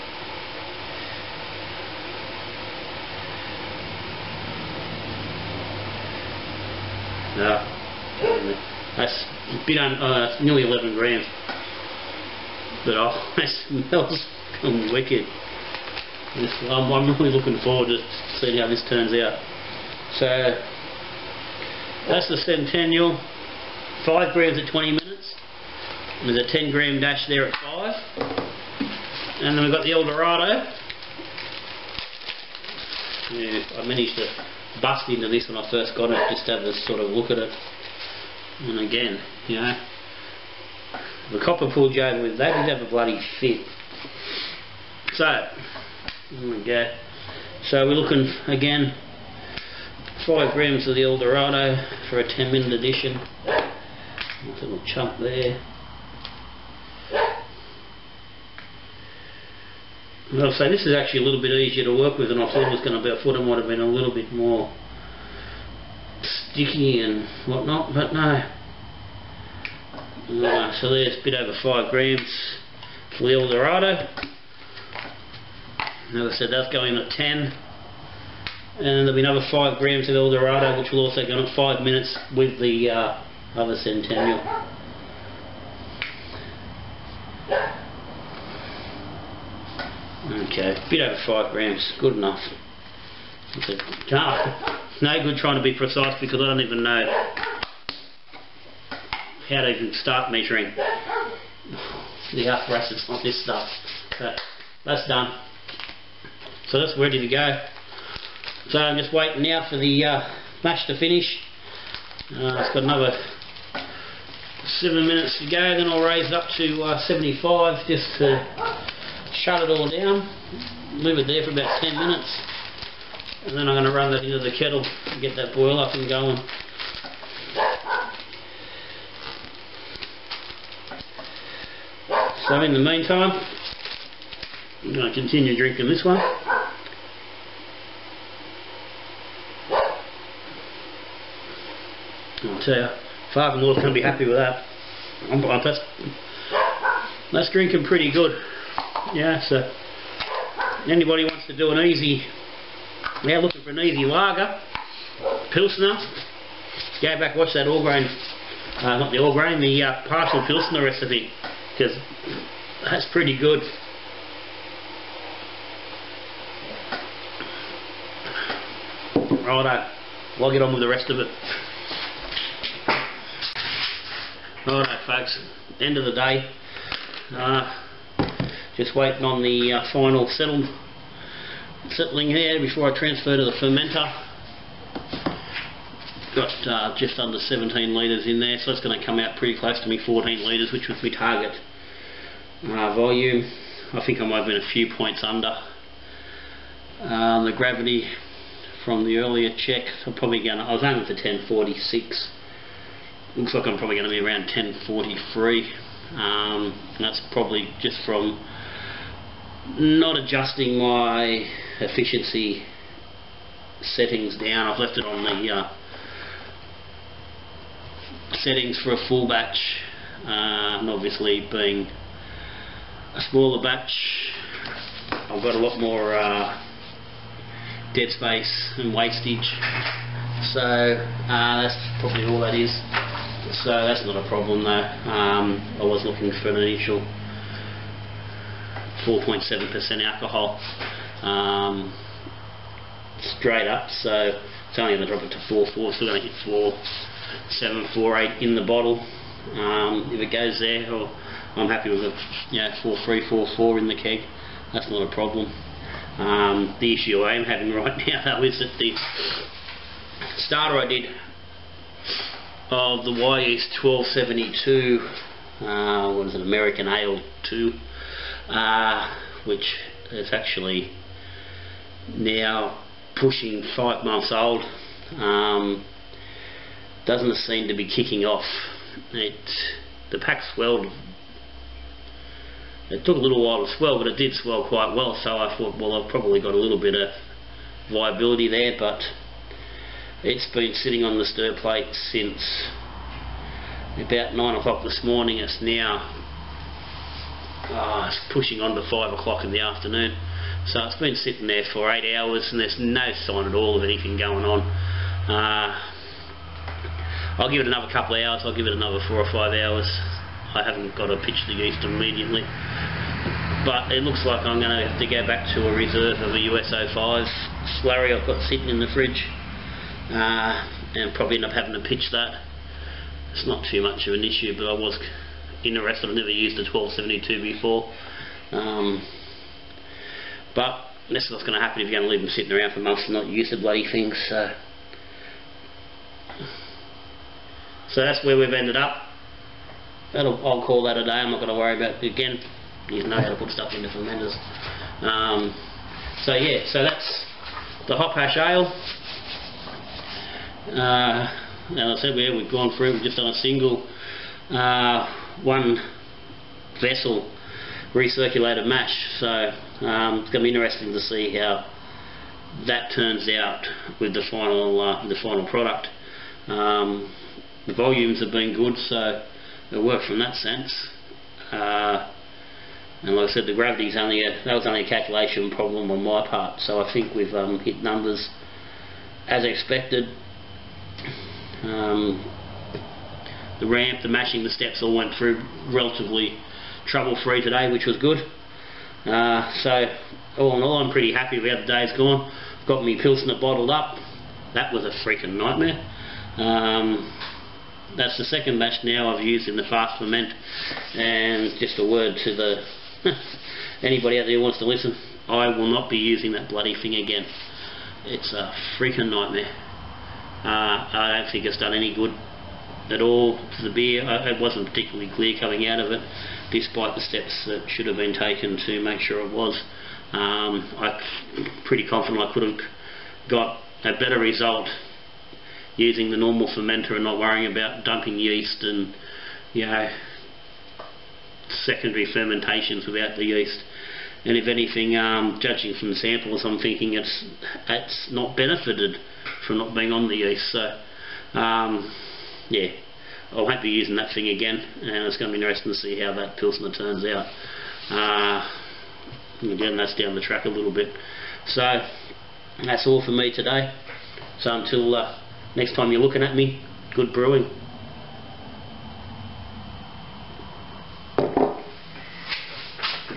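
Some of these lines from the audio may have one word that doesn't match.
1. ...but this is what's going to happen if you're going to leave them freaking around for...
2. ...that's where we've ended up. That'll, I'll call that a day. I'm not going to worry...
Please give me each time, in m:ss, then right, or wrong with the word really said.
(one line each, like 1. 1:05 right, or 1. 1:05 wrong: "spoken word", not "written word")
1. 5:30 wrong: "sitting", not "freaking"
2. 5:38 right.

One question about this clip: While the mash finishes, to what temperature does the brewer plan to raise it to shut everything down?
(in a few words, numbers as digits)
75.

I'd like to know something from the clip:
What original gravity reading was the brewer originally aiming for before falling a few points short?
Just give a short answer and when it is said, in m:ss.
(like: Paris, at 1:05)
1046, at 3:21.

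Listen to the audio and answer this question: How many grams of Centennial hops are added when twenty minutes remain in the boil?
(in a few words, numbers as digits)
5 grams.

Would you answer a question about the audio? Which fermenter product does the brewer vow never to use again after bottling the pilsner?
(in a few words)
FastFerment.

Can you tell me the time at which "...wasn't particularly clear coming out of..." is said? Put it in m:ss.
6:54.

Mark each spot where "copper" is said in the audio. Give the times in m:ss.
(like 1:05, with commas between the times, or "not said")
0:41.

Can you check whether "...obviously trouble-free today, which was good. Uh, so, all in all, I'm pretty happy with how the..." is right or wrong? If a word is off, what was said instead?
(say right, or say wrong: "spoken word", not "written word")
wrong: "relatively", not "obviously".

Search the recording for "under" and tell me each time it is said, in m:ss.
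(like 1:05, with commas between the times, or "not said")
3:07, 3:15.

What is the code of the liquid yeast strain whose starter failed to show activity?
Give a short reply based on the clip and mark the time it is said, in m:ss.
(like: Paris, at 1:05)
YS1272, at 4:23.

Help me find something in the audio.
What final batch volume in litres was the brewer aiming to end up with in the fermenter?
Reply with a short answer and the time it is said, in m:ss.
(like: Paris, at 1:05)
14 litres, at 3:10.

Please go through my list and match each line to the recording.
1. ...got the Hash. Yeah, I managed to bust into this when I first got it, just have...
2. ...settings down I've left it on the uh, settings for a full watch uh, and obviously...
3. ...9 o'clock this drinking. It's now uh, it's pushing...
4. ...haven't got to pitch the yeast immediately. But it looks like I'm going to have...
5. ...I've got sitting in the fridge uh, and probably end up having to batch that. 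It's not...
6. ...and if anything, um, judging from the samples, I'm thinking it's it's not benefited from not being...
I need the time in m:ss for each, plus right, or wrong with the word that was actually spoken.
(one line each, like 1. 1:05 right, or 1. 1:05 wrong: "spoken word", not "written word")
1. 0:29 wrong: "Eldorado", not "Hash"
2. 3:33 wrong: "batch", not "watch"
3. 4:54 wrong: "morning", not "drinking"
4. 5:10 right
5. 5:18 wrong: "pitch", not "batch"
6. 7:14 right.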